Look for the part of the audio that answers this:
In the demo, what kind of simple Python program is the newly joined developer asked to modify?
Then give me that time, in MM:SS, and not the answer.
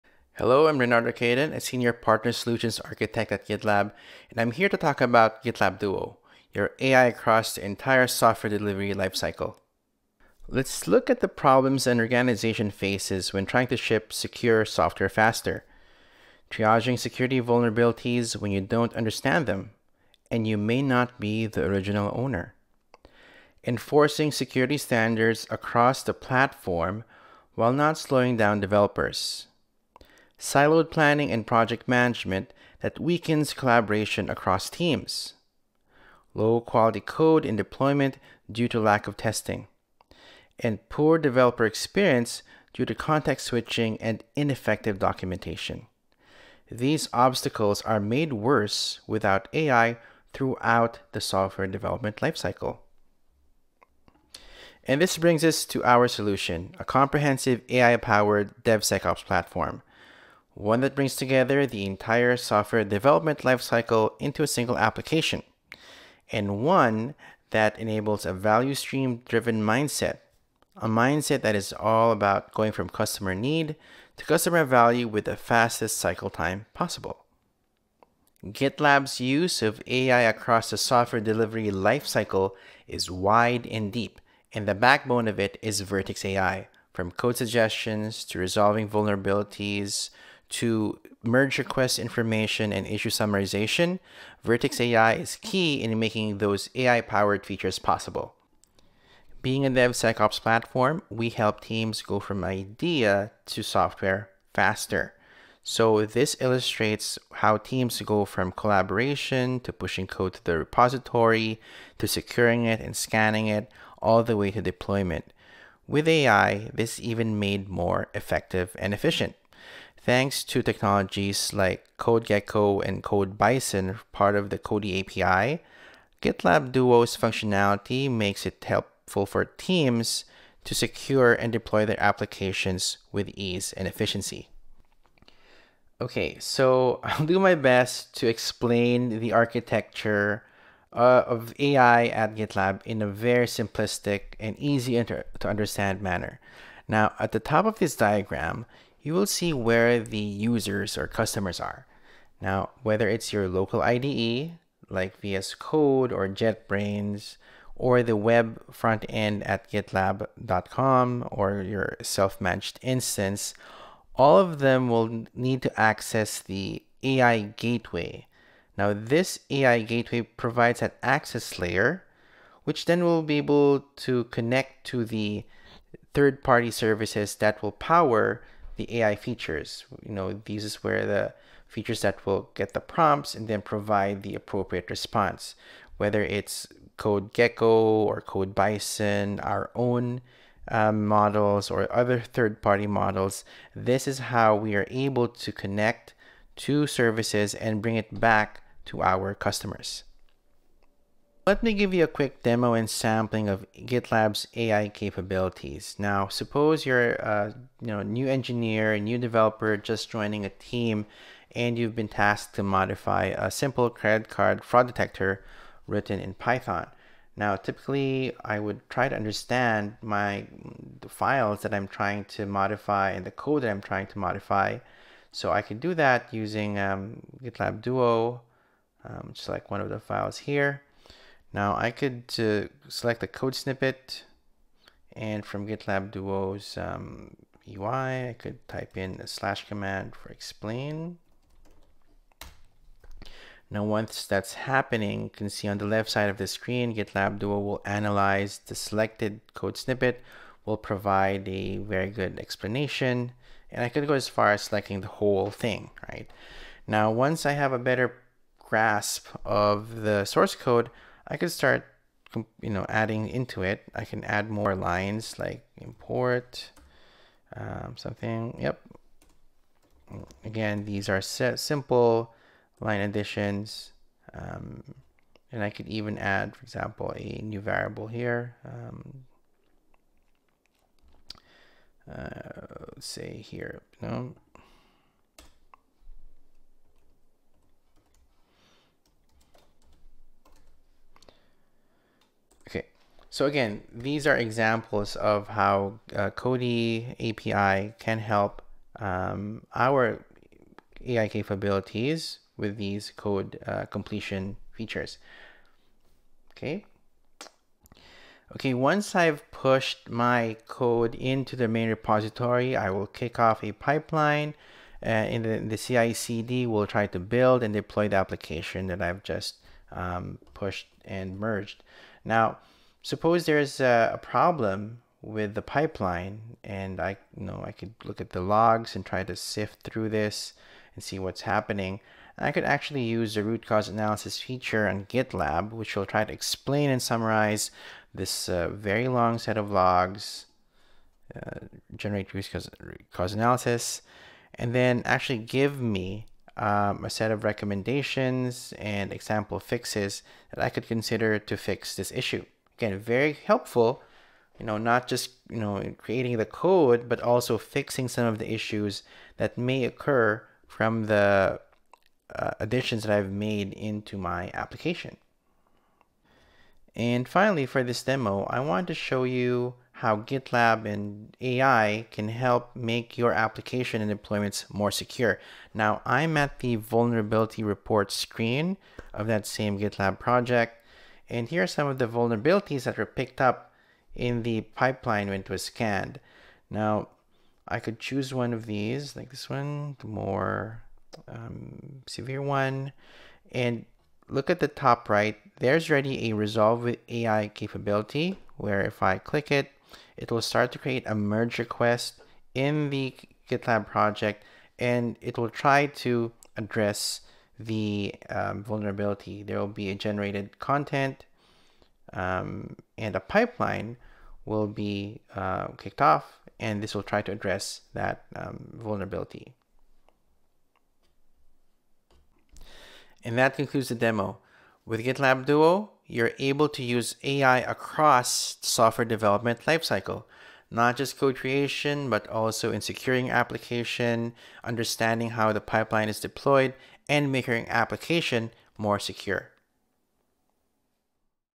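03:33.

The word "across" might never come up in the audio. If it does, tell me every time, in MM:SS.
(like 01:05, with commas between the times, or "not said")
00:07, 00:25, 00:34, 01:20, 07:07.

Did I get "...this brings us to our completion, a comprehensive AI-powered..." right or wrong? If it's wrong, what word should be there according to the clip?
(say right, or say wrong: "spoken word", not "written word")
wrong: "solution", not "completion".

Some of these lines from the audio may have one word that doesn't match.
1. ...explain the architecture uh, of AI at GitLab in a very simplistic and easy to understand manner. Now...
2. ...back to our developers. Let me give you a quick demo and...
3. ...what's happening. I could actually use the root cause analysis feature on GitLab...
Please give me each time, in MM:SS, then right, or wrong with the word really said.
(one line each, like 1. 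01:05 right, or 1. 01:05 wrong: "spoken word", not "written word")
1. 02:18 right
2. 03:18 wrong: "customers", not "developers"
3. 05:31 right.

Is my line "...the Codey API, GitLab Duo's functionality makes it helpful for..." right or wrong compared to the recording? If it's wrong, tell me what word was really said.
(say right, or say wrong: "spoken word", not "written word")
right.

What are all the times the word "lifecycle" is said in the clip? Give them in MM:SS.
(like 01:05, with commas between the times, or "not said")
00:08, 00:52, 01:03, 01:21, 07:09.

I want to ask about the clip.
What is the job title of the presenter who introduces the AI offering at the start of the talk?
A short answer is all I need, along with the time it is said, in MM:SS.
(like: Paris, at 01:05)
Senior Partner Solutions Architect, at 00:01.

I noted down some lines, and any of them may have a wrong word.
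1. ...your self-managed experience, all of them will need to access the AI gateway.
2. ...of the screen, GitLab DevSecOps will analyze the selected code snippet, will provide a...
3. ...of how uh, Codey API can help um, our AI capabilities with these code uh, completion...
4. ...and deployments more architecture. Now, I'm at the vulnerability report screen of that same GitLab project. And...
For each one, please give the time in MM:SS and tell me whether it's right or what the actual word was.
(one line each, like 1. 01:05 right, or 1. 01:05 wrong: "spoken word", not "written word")
1. 02:41 wrong: "instance", not "experience"
2. 04:06 wrong: "Duo", not "DevSecOps"
3. 04:55 right
4. 06:14 wrong: "secure", not "architecture".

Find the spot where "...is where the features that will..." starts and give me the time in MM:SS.
03:00.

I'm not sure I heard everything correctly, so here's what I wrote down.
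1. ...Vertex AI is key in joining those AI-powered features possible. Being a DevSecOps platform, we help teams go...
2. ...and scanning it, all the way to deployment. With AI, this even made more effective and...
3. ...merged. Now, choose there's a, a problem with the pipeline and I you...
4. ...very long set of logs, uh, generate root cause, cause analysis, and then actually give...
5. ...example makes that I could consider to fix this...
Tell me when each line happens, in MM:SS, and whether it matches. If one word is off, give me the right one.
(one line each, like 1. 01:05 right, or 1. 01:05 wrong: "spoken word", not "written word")
1. 01:34 wrong: "making", not "joining"
2. 01:52 right
3. 05:21 wrong: "suppose", not "choose"
4. 05:38 right
5. 05:49 wrong: "fixes", not "makes".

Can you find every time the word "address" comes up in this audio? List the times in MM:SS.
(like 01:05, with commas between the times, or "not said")
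06:46, 06:57.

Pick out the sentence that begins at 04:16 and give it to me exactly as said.
Now, once I have a better grasp of the source code, I could start, you know, adding into it.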